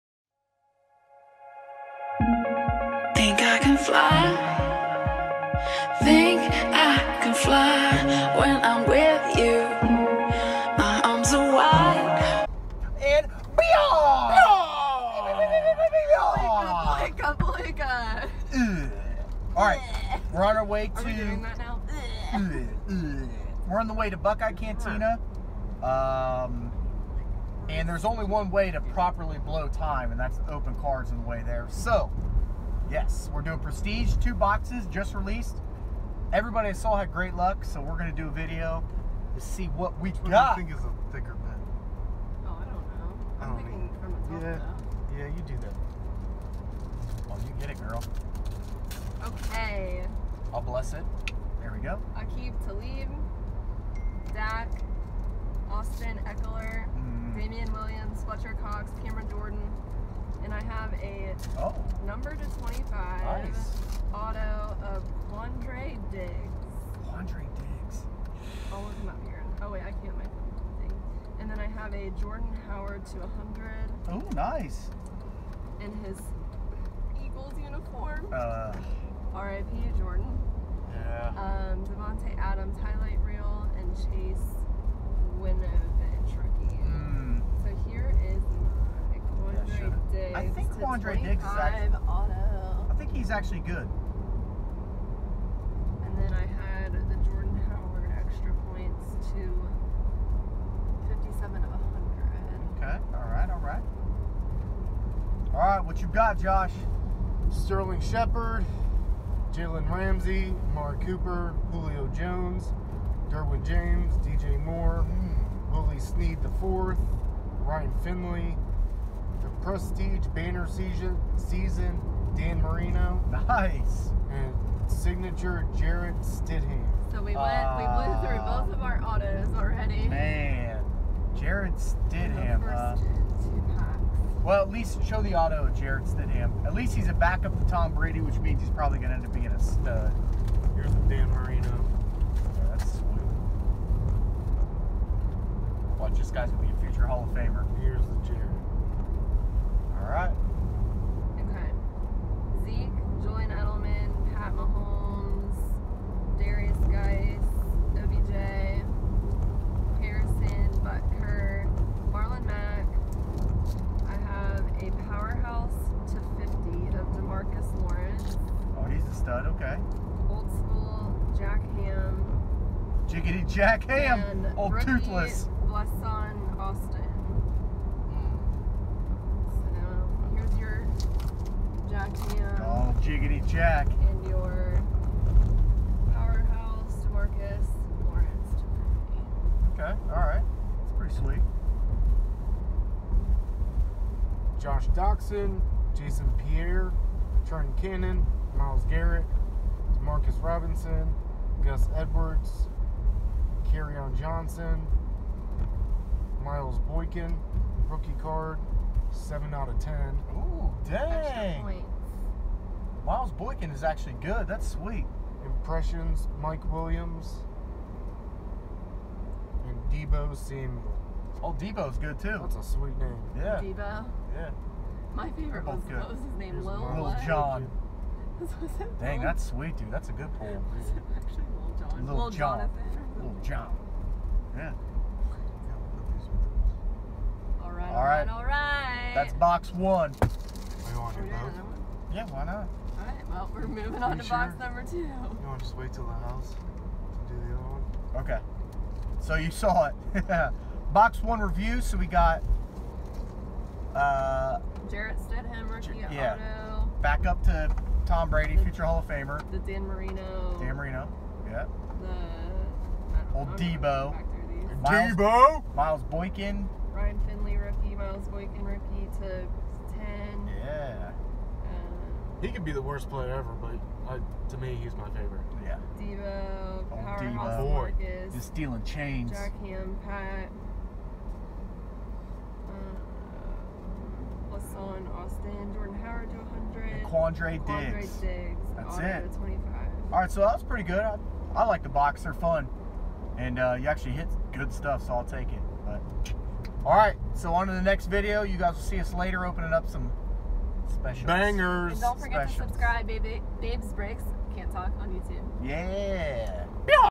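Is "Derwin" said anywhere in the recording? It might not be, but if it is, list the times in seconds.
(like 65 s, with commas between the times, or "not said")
113 s.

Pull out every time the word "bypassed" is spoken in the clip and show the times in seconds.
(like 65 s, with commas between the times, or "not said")
not said.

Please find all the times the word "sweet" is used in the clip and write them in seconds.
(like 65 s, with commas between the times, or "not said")
142 s, 191 s, 214 s, 222 s, 229 s.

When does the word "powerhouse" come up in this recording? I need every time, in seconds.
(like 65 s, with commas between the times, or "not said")
165 s, 186 s, 276 s.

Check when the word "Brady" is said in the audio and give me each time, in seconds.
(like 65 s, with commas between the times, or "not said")
137 s, 258 s.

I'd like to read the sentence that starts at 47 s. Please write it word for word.
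Well, oh, you get it, girl.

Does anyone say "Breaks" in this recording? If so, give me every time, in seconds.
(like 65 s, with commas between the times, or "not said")
303 s.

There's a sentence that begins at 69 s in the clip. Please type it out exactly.
Oh, wait, I can't make thing.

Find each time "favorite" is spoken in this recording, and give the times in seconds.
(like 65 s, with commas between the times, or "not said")
225 s, 275 s.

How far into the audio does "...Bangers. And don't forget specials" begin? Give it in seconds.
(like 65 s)
301 s.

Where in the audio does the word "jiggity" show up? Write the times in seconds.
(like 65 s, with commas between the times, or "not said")
173 s, 183 s.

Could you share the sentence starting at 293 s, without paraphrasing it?
And uh, you actually hit good stuff, so I'll take it.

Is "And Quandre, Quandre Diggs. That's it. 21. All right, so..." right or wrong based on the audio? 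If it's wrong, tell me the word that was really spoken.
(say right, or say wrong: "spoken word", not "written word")
wrong: "25", not "21".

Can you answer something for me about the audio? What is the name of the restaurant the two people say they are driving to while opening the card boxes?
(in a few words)
Buckeye Cantina.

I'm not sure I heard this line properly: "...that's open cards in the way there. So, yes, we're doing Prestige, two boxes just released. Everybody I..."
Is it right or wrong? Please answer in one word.
right.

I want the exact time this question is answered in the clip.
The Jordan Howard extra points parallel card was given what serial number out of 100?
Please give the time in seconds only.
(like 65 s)
101 s.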